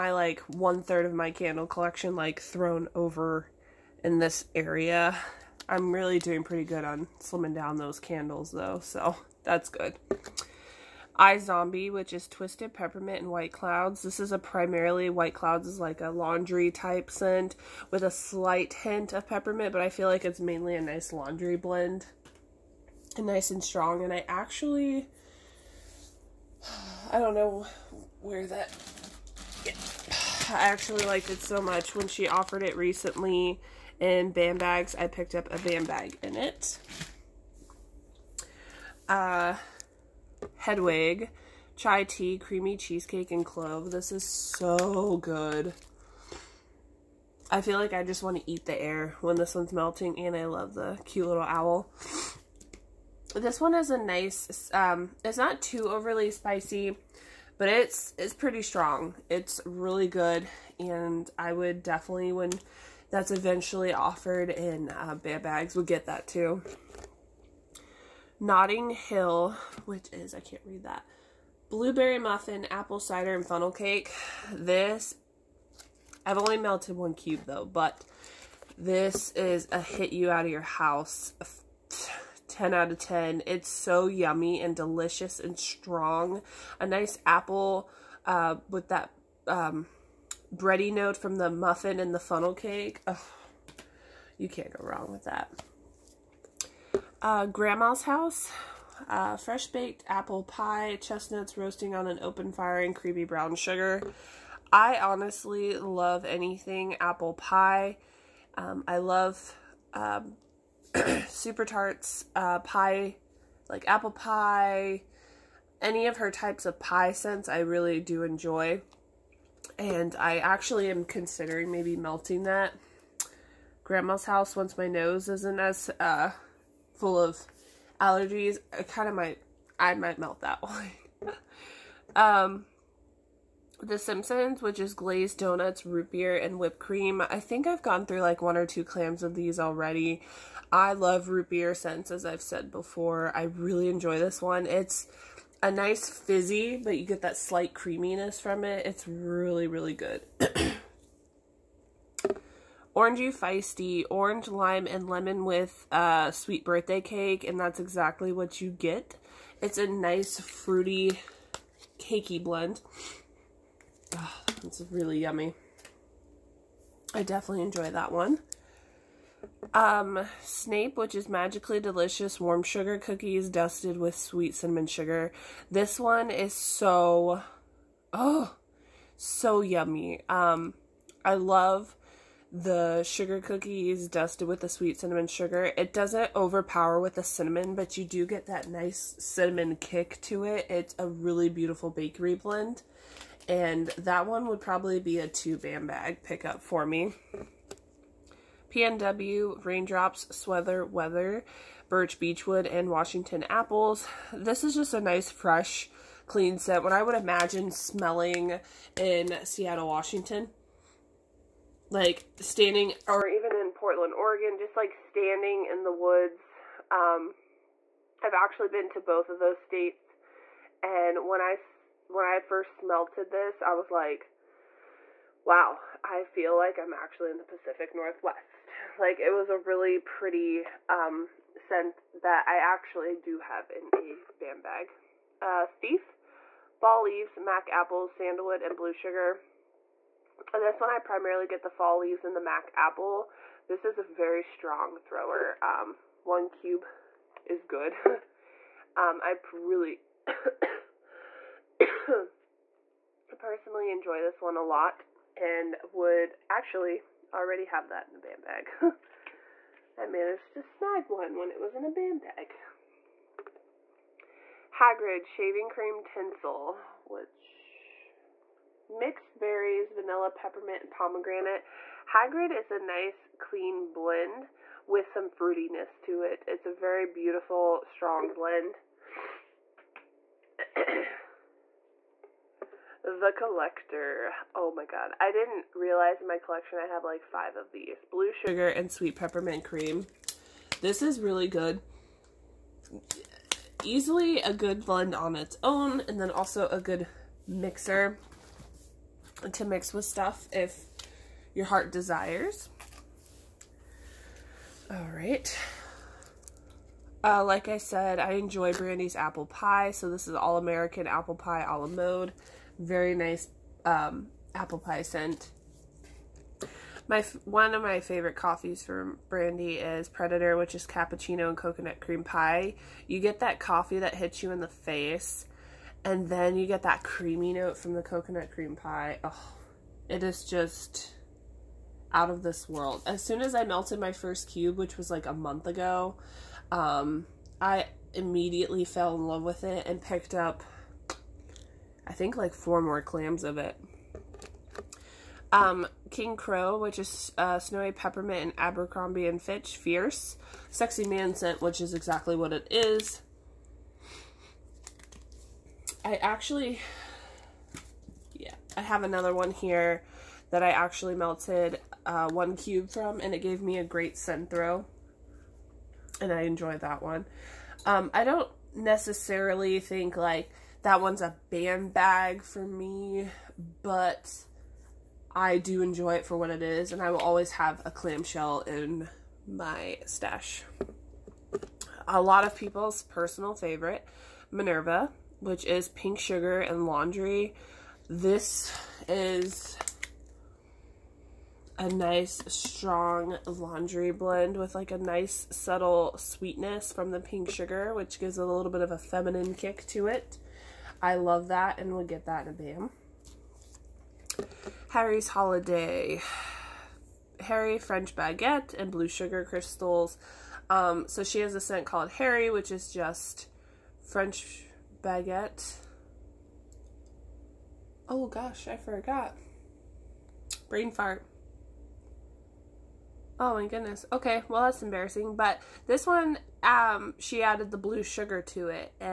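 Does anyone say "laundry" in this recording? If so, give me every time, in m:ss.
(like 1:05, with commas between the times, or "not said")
0:16, 0:21, 6:26, 6:33.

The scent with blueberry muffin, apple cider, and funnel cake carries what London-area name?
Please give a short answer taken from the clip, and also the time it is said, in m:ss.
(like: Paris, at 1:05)
Notting Hill, at 1:08.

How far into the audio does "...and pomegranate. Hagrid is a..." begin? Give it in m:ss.
4:30.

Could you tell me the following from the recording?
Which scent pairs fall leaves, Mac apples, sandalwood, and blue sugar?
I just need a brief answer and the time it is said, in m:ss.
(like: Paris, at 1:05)
Thief, at 3:55.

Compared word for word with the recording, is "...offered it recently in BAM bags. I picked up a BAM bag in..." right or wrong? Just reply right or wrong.
right.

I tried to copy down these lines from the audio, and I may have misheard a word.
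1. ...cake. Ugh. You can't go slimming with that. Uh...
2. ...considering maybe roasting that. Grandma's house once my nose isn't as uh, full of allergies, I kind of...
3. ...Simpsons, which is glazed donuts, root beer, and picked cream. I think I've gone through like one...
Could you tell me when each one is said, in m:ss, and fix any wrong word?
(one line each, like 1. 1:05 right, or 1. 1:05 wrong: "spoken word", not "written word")
1. 1:32 wrong: "wrong", not "slimming"
2. 2:01 wrong: "melting", not "roasting"
3. 2:13 wrong: "whipped", not "picked".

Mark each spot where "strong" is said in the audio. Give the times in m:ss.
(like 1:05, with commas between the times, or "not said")
0:23, 0:58, 1:25, 4:04, 4:37, 6:32.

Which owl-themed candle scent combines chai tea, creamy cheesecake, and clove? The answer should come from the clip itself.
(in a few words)
Hedwig.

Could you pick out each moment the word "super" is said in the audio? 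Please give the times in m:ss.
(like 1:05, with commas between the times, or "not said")
1:51.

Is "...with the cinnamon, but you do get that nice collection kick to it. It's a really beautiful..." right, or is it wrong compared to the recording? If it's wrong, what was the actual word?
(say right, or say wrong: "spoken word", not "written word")
wrong: "cinnamon", not "collection".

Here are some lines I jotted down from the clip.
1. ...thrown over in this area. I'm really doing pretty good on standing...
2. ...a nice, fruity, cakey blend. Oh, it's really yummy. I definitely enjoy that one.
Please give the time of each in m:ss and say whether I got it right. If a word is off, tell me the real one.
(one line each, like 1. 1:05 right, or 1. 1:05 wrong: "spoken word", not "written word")
1. 0:02 wrong: "slimming", not "standing"
2. 2:39 right.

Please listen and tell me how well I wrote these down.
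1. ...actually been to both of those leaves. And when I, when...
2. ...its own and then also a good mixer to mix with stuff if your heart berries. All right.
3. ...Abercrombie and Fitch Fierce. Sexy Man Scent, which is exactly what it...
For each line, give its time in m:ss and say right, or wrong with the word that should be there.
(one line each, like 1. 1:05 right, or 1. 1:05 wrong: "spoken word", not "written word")
1. 3:38 wrong: "states", not "leaves"
2. 4:55 wrong: "desires", not "berries"
3. 5:48 right.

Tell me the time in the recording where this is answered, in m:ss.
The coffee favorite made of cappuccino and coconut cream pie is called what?
5:20.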